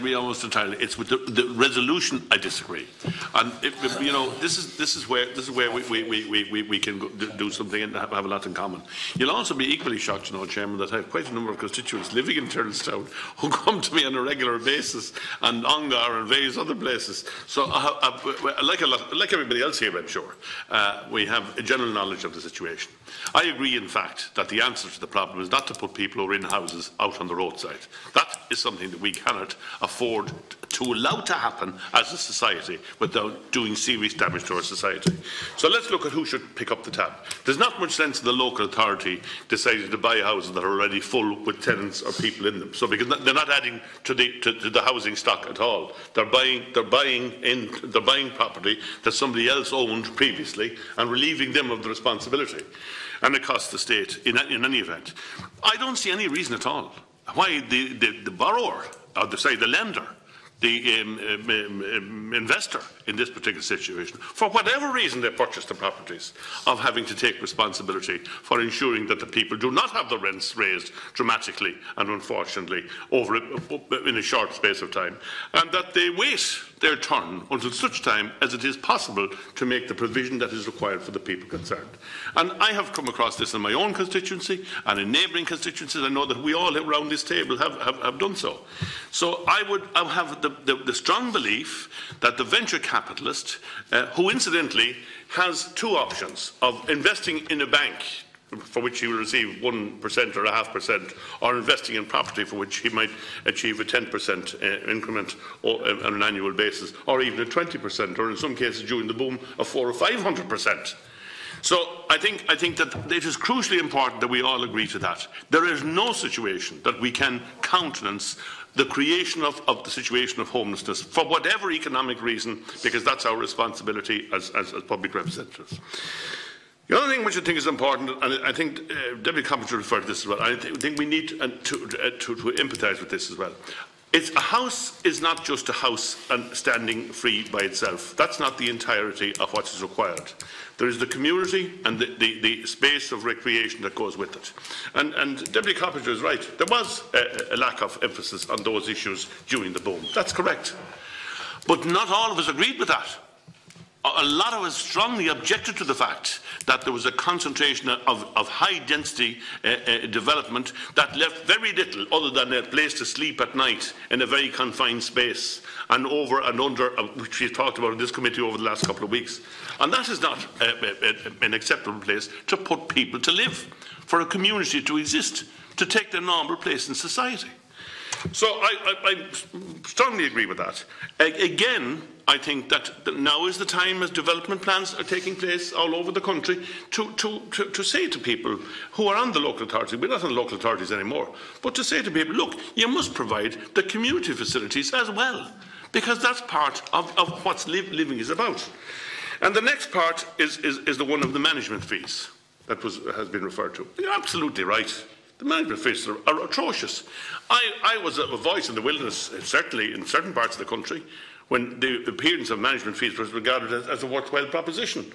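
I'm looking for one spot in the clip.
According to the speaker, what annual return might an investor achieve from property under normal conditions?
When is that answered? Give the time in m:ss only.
1:43.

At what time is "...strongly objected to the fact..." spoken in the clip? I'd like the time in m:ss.
2:34.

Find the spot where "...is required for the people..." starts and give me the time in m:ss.
1:20.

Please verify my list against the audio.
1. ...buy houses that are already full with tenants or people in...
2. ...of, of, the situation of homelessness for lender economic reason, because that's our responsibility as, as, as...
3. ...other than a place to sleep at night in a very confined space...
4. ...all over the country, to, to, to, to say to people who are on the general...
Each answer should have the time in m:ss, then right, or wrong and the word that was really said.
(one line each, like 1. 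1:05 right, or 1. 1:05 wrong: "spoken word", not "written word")
1. 0:39 right
2. 1:59 wrong: "whatever", not "lender"
3. 2:42 right
4. 3:05 wrong: "local", not "general".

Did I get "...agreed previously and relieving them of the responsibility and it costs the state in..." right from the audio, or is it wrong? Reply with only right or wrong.
wrong.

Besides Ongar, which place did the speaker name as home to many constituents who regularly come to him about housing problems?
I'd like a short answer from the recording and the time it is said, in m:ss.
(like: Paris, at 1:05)
Tyrrelstown, at 0:12.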